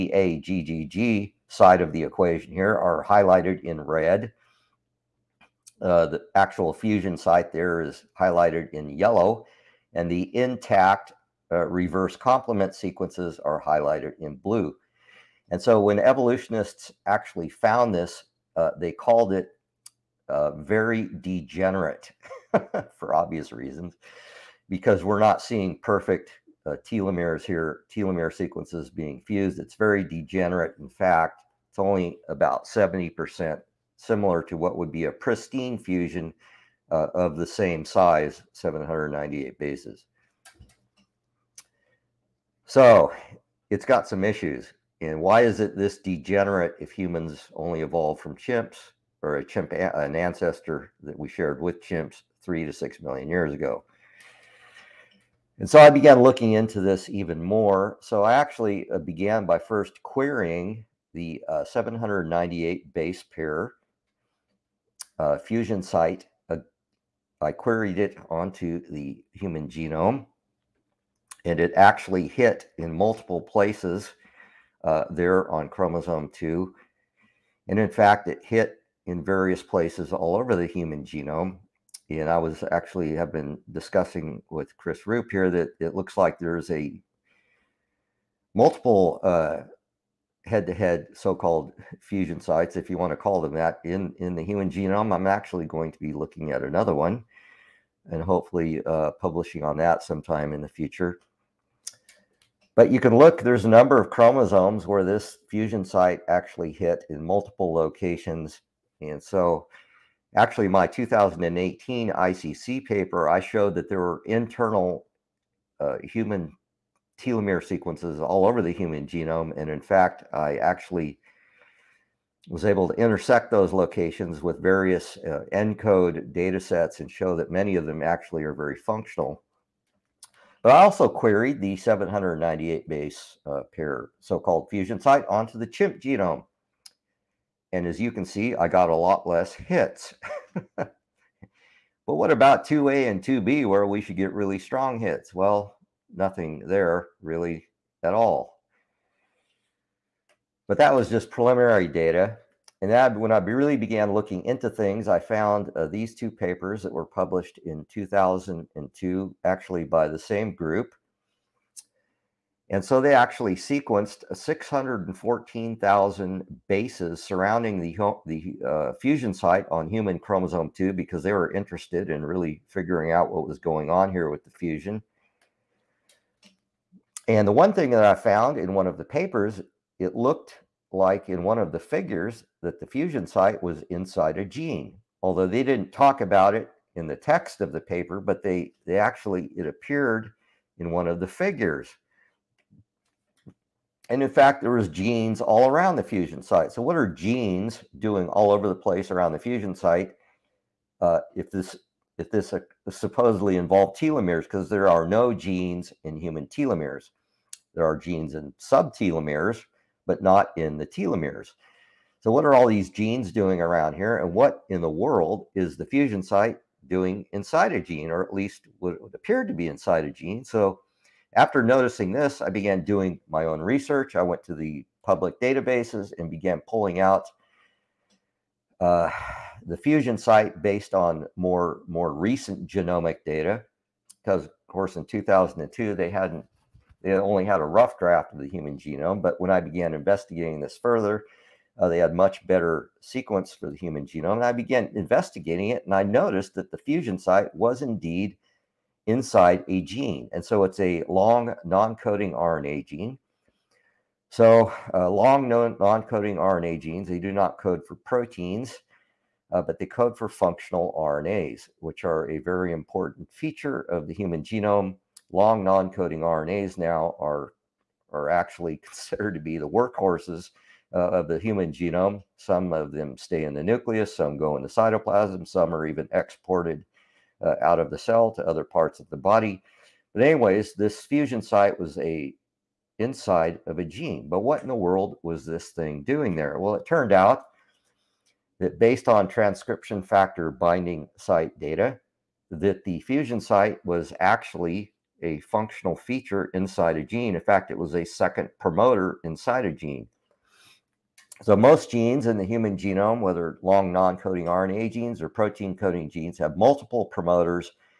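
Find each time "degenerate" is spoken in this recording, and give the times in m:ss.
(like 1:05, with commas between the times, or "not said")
0:21, 0:30, 0:45.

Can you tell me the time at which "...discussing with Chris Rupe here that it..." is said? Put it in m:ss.
1:23.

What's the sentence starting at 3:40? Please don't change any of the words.
So after noticing this, I began doing my own research.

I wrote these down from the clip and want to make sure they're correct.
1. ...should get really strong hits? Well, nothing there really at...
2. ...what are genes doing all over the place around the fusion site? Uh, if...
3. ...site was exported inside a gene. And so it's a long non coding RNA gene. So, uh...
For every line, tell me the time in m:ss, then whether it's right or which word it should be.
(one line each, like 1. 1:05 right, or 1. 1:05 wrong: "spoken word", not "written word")
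1. 2:23 right
2. 3:16 right
3. 4:07 wrong: "indeed", not "exported".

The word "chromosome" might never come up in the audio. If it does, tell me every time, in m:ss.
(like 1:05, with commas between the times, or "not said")
1:15, 1:44, 2:50.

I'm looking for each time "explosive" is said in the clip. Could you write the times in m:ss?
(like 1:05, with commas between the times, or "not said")
not said.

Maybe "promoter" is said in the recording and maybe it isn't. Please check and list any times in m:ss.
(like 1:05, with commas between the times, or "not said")
4:58, 5:07.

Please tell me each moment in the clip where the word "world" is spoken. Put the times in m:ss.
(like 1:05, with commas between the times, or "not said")
3:34, 4:44.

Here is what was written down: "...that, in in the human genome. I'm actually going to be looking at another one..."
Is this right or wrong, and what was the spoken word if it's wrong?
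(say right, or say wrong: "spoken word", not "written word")
right.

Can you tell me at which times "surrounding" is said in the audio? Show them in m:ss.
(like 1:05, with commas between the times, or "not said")
2:47.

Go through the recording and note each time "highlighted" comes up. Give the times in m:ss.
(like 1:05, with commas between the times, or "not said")
0:03, 0:08, 0:13.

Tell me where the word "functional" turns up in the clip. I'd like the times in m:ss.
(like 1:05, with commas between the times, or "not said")
2:08, 4:20, 4:55.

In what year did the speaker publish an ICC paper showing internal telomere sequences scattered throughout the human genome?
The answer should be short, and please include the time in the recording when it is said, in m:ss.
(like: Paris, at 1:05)
2018, at 1:50.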